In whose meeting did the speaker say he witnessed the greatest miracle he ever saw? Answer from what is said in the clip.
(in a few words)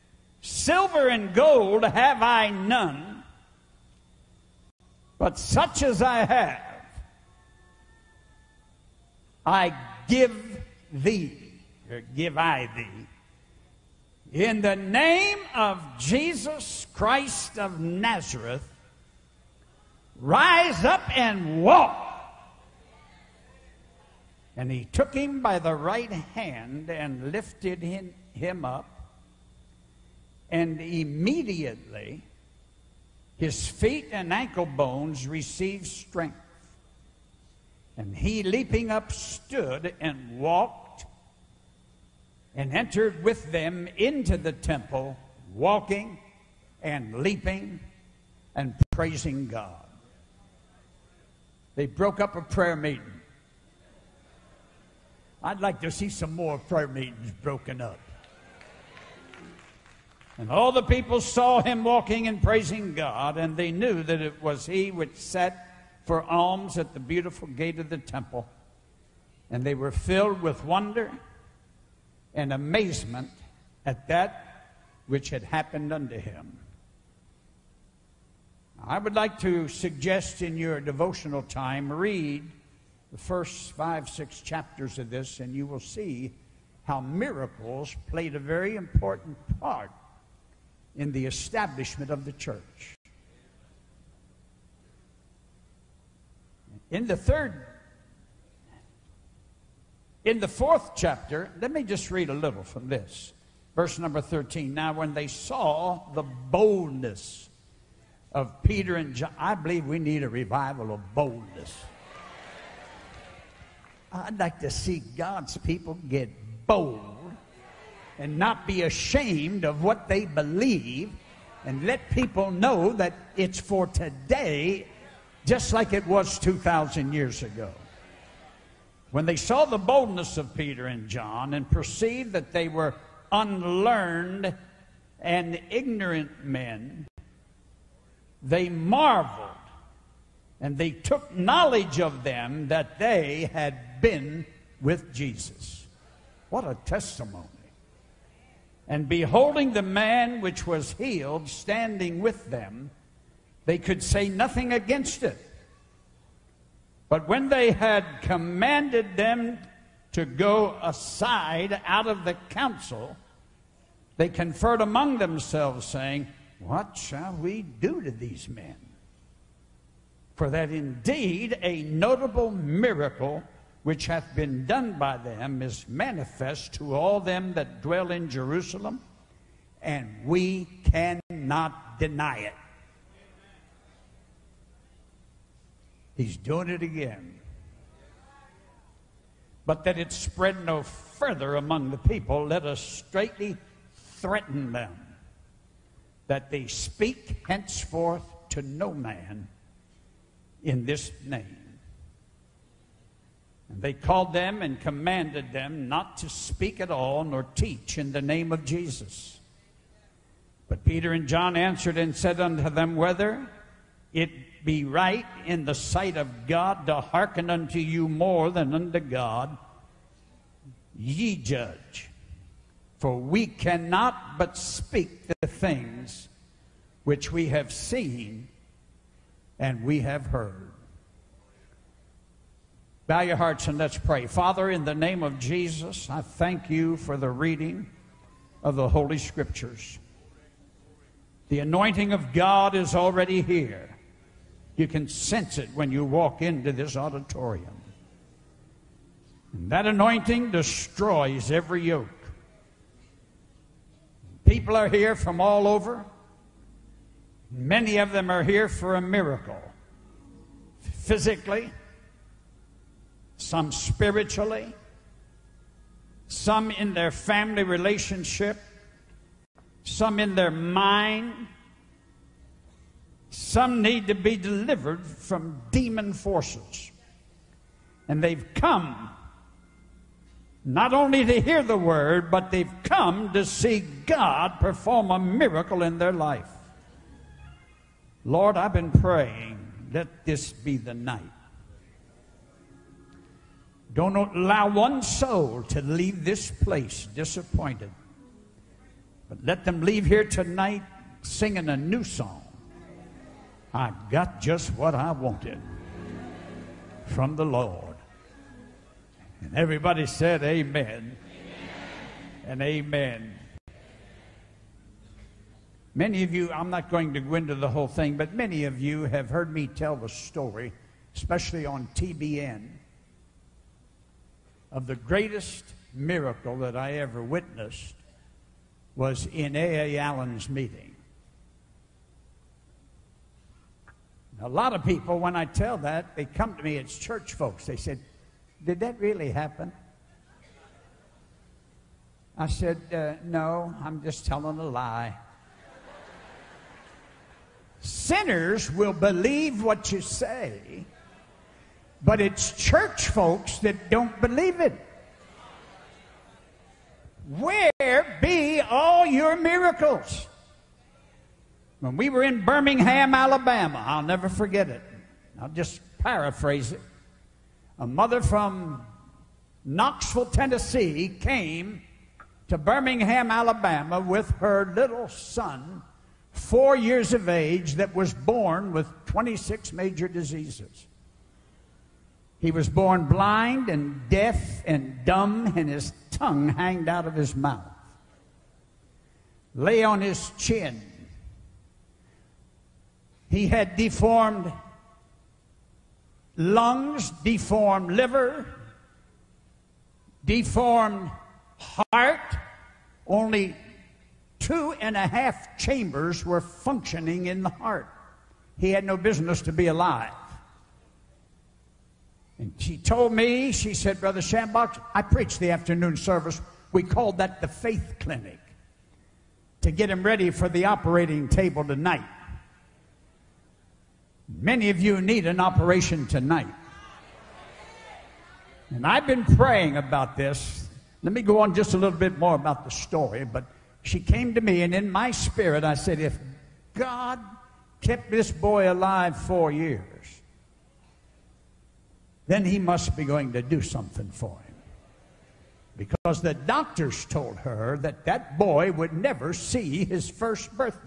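A.A. Allen.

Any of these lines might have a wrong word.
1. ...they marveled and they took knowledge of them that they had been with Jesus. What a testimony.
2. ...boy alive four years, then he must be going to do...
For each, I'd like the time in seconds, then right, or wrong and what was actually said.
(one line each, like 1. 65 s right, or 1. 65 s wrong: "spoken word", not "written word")
1. 138 s right
2. 438 s right.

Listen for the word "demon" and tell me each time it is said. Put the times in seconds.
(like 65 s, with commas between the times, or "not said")
275 s.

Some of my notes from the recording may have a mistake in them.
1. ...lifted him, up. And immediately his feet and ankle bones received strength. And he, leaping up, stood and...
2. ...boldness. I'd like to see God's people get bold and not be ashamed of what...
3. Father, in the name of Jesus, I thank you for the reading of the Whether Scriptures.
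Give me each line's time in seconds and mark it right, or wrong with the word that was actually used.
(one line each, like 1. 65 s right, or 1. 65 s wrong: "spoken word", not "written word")
1. 27 s right
2. 111 s right
3. 234 s wrong: "Holy", not "Whether".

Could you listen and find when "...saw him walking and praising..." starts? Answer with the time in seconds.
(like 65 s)
61 s.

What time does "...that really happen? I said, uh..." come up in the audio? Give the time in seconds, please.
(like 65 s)
338 s.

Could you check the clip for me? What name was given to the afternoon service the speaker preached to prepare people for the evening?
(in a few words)
faith clinic.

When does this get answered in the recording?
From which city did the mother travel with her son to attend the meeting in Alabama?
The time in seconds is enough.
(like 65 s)
369 s.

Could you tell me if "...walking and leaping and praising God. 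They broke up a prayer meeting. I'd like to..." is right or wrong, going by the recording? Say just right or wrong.
right.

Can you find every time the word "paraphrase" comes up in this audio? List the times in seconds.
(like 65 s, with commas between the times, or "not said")
365 s.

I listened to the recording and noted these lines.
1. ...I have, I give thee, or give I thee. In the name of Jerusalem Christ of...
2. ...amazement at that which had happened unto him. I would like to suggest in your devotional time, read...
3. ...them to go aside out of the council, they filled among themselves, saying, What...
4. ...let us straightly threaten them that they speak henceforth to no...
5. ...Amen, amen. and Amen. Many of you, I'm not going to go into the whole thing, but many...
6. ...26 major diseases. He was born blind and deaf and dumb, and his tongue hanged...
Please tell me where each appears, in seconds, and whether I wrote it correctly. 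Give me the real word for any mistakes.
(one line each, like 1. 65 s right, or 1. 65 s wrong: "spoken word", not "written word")
1. 6 s wrong: "Jesus", not "Jerusalem"
2. 72 s right
3. 159 s wrong: "conferred", not "filled"
4. 192 s right
5. 310 s right
6. 379 s right.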